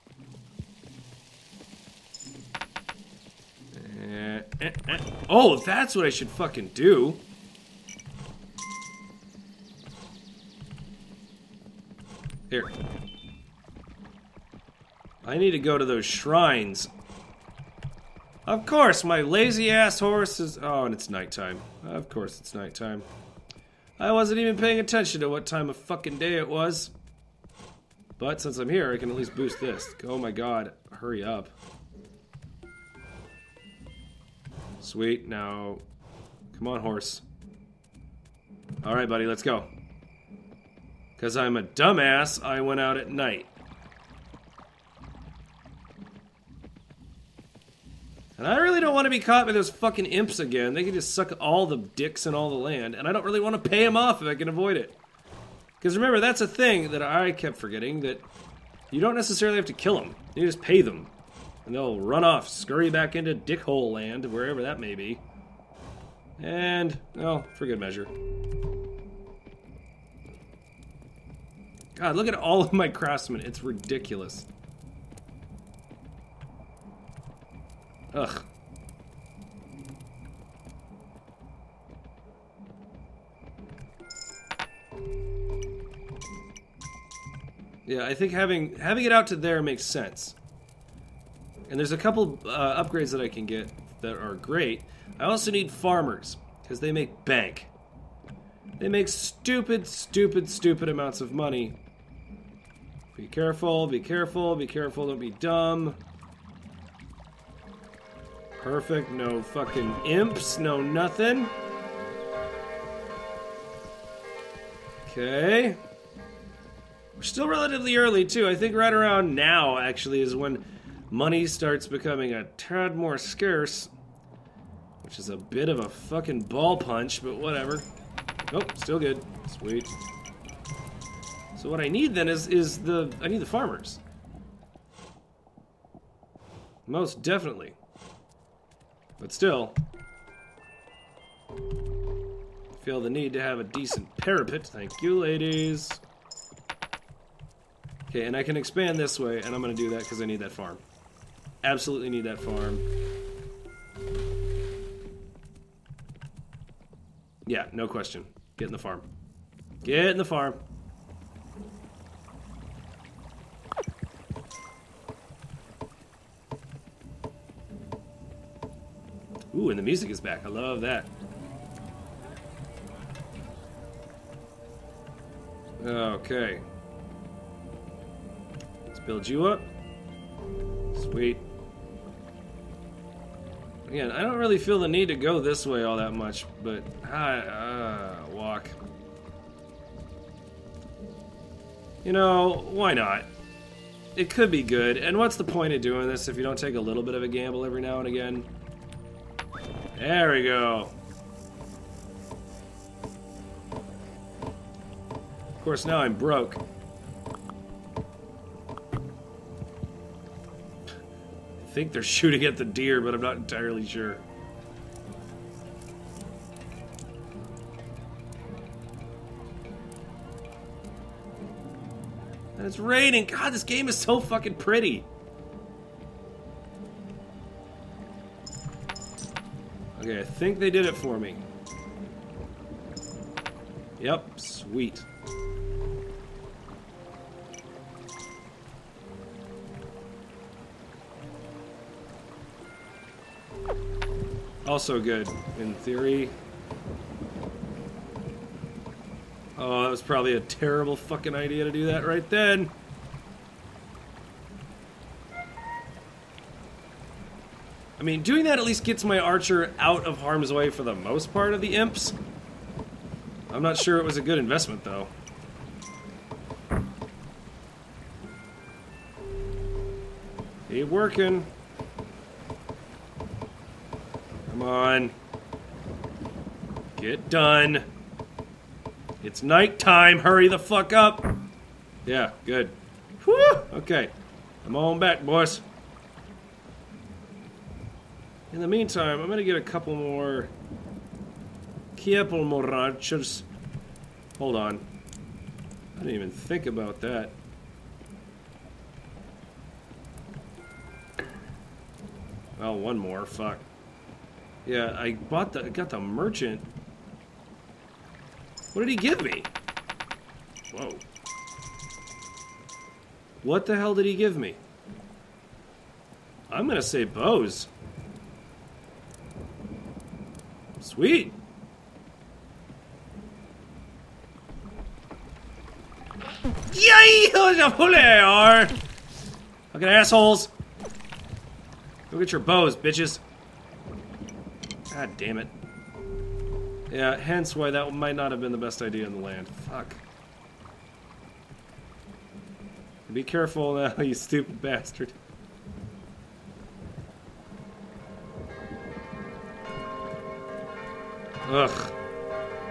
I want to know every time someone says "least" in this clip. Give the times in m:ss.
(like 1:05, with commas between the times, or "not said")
0:29, 4:18.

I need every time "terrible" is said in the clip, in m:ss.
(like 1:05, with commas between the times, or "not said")
4:10.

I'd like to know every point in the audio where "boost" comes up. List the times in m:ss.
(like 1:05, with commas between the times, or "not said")
0:29.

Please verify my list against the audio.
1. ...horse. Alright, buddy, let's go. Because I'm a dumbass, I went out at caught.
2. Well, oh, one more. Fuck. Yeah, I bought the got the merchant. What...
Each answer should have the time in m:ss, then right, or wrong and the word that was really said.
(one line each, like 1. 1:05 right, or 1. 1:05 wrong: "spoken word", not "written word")
1. 0:36 wrong: "night", not "caught"
2. 5:02 right.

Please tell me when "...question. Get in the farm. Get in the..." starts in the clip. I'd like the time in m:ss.
2:37.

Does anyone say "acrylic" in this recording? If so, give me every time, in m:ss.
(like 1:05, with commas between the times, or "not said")
not said.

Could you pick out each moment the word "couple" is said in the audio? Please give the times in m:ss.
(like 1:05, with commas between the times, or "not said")
1:31, 4:49.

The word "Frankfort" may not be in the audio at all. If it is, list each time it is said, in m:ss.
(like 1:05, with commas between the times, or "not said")
not said.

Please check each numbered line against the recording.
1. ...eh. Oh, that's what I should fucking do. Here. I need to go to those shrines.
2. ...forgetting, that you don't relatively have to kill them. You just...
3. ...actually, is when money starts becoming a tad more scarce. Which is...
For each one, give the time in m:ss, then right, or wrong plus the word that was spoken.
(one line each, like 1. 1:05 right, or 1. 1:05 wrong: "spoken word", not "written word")
1. 0:04 right
2. 0:57 wrong: "necessarily", not "relatively"
3. 1:59 right.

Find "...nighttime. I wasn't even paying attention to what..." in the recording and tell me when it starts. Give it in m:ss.
0:22.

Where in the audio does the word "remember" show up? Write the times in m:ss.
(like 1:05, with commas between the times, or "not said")
0:55.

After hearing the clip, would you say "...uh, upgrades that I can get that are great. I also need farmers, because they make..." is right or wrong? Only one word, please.
right.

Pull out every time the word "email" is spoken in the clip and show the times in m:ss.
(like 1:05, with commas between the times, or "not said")
not said.